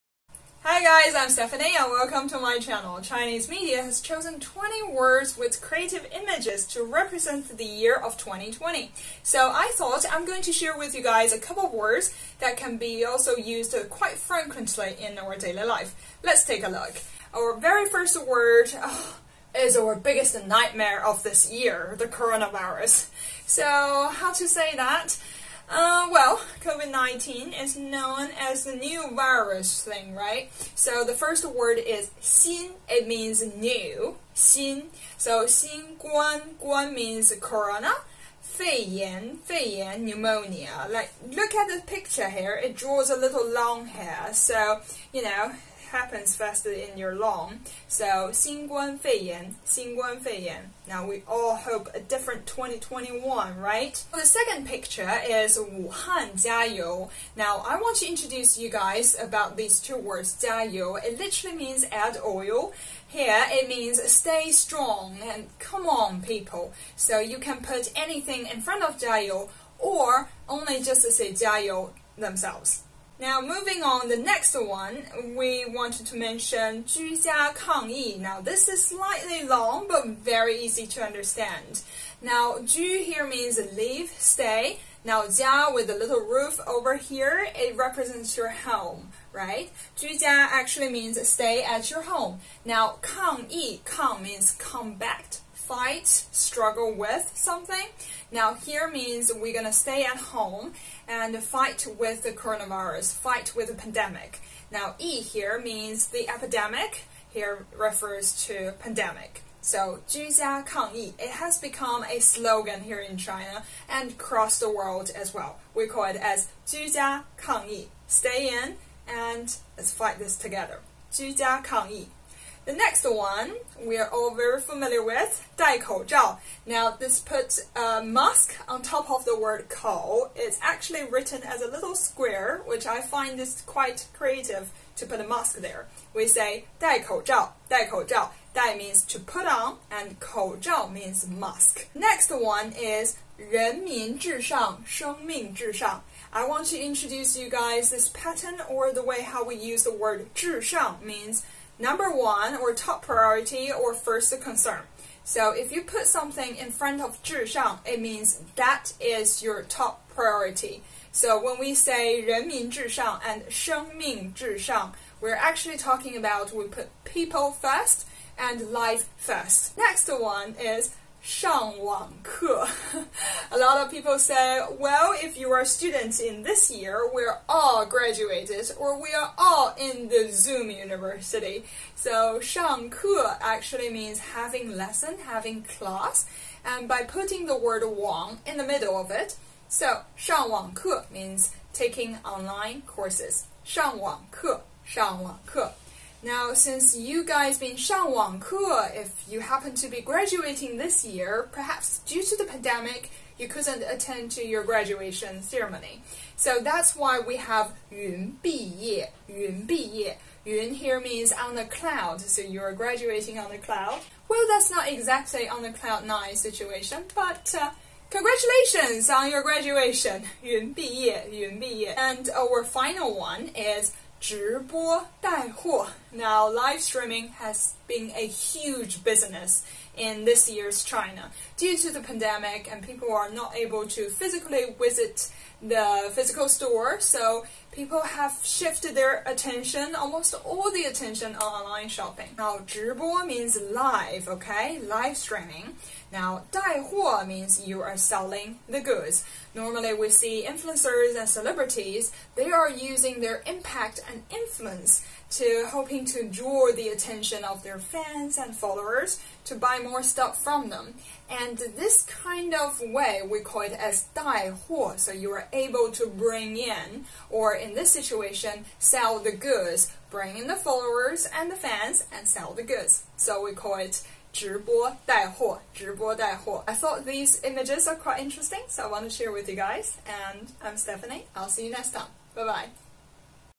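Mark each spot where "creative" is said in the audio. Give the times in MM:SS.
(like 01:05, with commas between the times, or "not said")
00:05, 02:14.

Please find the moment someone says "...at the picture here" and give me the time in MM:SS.
00:41.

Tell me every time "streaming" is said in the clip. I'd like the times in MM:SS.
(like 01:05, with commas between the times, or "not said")
03:46, 04:05.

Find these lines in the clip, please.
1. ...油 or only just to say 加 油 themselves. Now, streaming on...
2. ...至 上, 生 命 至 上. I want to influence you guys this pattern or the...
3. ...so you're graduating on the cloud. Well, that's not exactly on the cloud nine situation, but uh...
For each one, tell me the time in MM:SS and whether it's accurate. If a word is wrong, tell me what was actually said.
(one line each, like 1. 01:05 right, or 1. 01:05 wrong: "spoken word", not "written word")
1. 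01:09 wrong: "moving", not "streaming"
2. 02:24 wrong: "introduce", not "influence"
3. 03:32 right.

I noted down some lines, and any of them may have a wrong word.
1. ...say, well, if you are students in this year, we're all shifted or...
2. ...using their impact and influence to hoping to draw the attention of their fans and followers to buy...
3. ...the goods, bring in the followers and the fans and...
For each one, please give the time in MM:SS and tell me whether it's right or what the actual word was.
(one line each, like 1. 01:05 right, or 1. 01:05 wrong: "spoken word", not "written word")
1. 02:54 wrong: "graduated", not "shifted"
2. 04:12 right
3. 04:29 right.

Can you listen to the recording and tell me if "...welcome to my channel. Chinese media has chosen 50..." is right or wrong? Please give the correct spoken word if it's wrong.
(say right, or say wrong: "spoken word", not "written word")
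wrong: "20", not "50".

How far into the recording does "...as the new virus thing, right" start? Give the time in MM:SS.
00:28.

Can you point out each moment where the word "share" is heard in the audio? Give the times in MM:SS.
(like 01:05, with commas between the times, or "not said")
00:10, 04:39.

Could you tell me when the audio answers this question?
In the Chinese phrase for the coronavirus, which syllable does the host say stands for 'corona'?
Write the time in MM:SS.
00:36.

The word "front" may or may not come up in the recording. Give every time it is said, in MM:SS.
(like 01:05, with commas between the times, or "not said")
01:08, 02:36.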